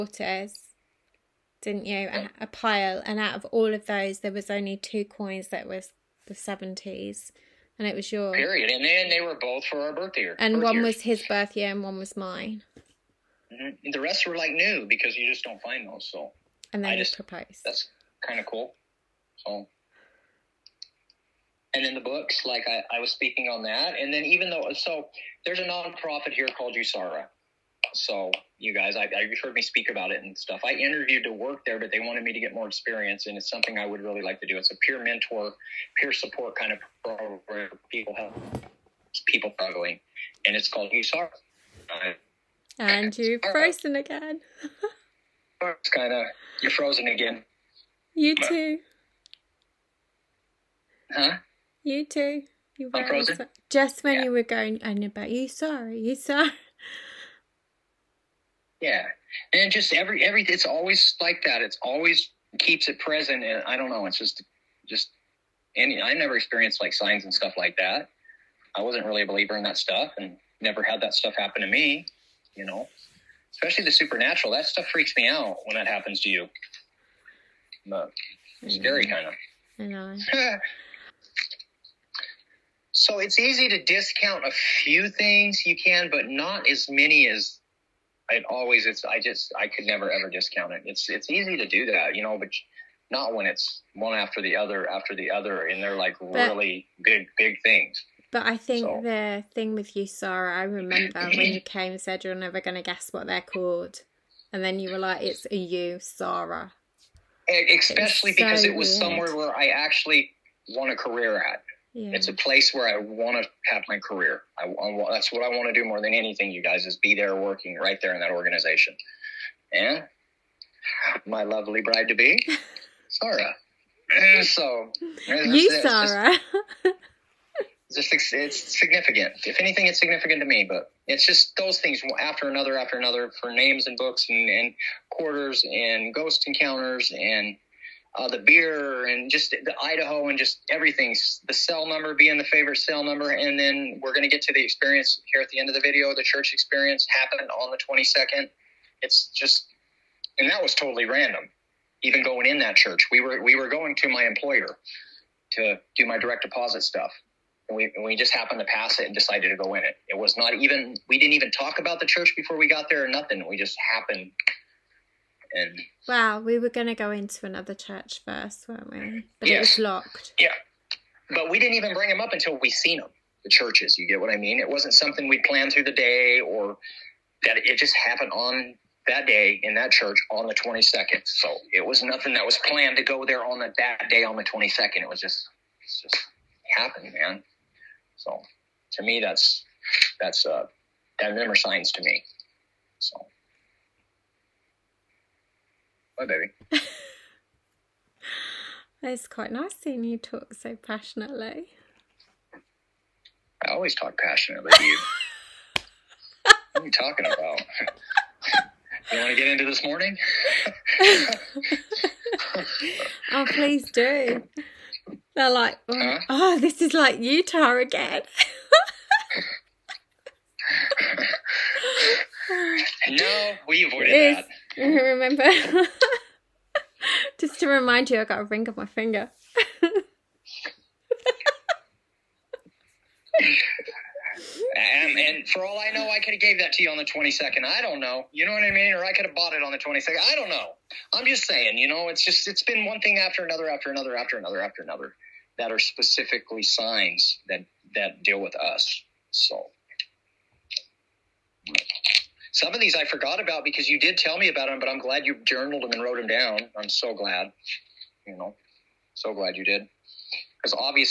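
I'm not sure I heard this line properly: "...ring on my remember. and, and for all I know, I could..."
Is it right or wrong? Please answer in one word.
wrong.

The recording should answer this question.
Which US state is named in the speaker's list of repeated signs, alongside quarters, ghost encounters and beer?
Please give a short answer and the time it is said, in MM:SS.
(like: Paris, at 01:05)
Idaho, at 02:19.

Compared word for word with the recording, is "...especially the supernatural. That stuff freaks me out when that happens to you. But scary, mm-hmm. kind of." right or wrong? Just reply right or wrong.
right.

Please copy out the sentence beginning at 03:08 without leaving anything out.
So to me, that's, that's, uh, that number signs to me.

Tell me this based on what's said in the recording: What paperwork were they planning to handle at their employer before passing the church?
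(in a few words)
direct deposit.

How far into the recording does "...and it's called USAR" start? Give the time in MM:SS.
00:40.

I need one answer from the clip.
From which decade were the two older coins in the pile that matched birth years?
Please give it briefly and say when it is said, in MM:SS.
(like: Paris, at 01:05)
the 70s, at 00:06.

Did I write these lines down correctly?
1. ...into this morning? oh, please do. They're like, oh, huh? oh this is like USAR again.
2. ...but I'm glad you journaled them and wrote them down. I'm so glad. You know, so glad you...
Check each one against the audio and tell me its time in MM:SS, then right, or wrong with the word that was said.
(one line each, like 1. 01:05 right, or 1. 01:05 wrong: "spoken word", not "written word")
1. 03:29 wrong: "Utah", not "USAR"
2. 04:14 right.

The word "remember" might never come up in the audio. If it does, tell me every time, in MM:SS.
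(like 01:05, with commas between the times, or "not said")
01:40, 03:44.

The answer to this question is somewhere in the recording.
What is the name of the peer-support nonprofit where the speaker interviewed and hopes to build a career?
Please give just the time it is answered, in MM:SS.
00:26.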